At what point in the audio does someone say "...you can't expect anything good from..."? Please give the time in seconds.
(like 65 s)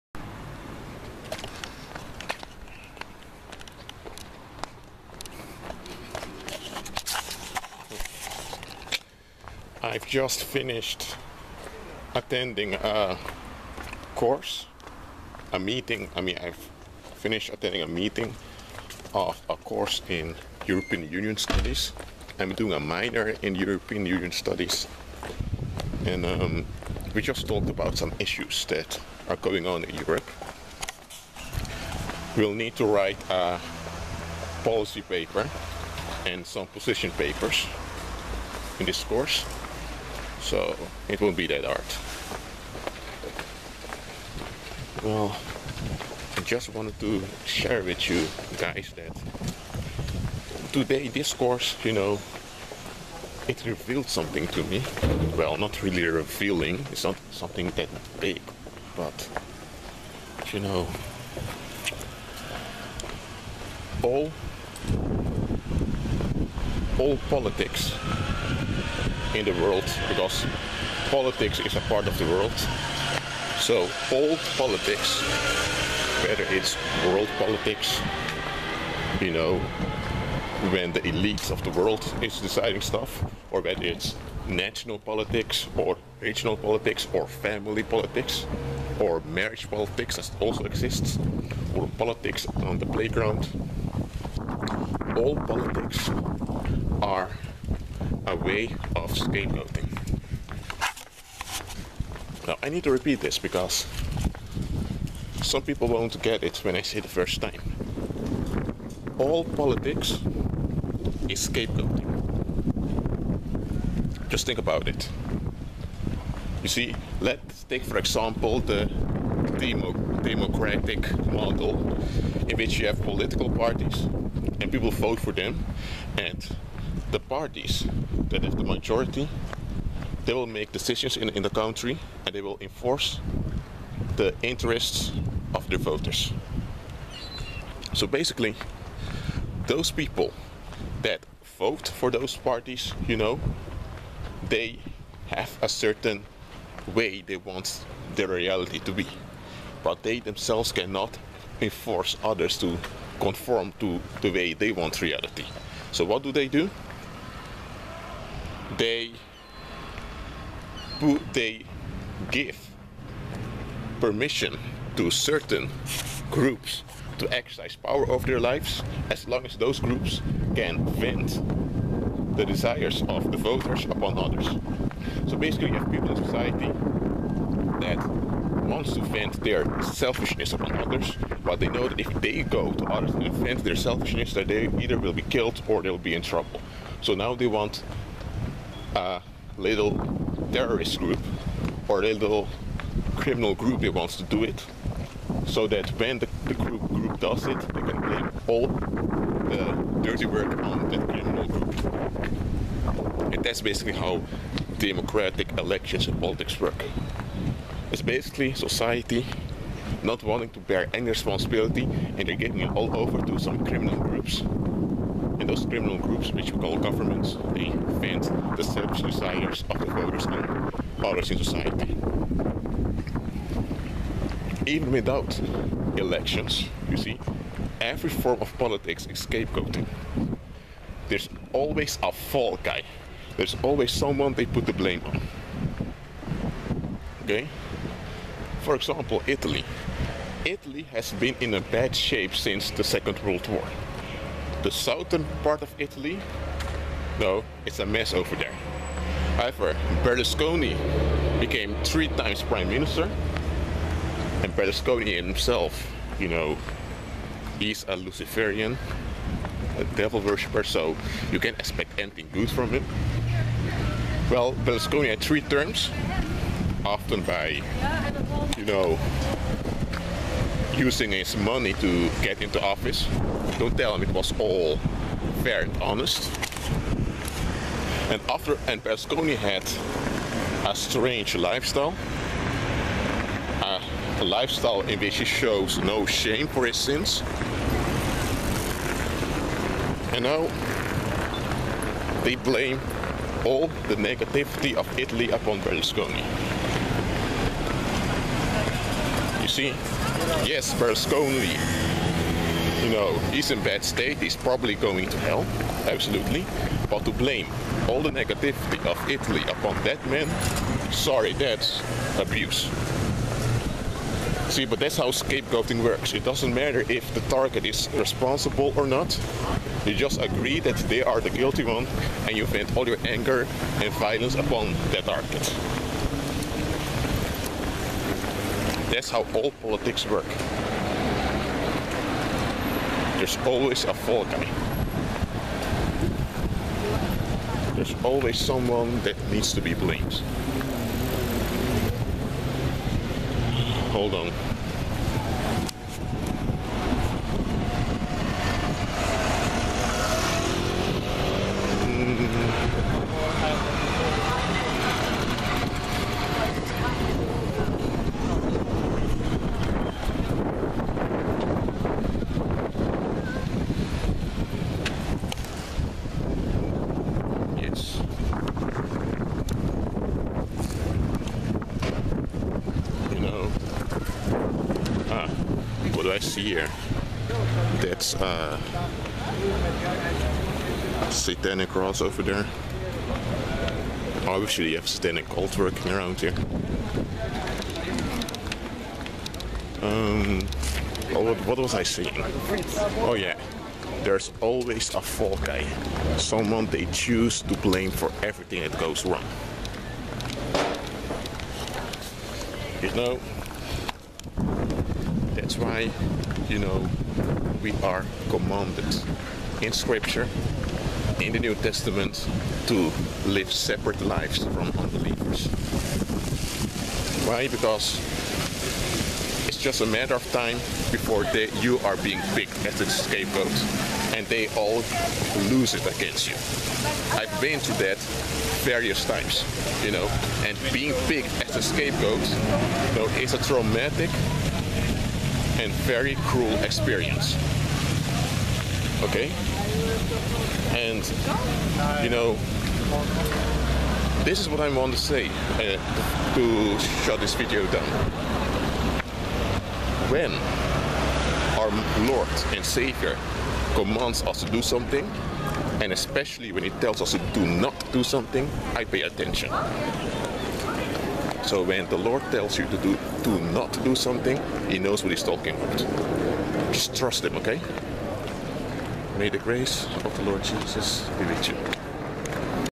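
261 s.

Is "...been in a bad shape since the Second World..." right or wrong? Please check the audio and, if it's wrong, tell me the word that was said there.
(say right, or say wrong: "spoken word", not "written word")
right.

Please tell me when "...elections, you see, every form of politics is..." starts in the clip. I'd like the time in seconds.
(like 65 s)
225 s.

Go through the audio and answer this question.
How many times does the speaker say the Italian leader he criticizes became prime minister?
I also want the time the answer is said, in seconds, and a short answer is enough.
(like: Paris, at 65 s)
3, at 251 s.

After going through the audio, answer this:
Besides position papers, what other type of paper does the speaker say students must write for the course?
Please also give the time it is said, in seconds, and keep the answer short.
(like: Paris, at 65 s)
policy paper, at 34 s.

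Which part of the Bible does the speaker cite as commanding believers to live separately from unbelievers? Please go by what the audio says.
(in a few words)
the New Testament.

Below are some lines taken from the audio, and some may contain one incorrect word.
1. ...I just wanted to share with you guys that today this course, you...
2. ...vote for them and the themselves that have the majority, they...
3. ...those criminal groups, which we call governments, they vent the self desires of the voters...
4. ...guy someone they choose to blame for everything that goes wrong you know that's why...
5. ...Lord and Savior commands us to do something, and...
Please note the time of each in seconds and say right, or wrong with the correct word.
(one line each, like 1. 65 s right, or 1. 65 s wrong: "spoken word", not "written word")
1. 46 s right
2. 124 s wrong: "parties", not "themselves"
3. 215 s right
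4. 395 s right
5. 452 s right.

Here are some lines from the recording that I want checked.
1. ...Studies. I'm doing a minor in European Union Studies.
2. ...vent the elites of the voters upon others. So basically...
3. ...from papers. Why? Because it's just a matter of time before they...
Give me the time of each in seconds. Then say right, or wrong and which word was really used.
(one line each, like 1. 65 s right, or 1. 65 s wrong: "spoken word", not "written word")
1. 21 s right
2. 170 s wrong: "desires", not "elites"
3. 414 s wrong: "unbelievers", not "papers".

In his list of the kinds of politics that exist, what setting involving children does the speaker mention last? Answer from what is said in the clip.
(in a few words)
the playground.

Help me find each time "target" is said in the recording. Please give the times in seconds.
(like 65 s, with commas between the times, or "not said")
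317 s, 325 s.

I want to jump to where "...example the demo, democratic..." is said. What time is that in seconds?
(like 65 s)
117 s.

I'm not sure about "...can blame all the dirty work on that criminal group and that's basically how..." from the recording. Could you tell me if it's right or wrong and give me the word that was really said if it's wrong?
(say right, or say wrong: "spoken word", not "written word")
right.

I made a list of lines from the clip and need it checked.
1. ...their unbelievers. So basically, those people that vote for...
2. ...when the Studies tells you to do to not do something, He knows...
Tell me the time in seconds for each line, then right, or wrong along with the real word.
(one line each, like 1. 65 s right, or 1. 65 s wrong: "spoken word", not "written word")
1. 135 s wrong: "voters", not "unbelievers"
2. 461 s wrong: "Lord", not "Studies".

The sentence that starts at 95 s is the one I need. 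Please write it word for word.
All politics are a way of scapegoating.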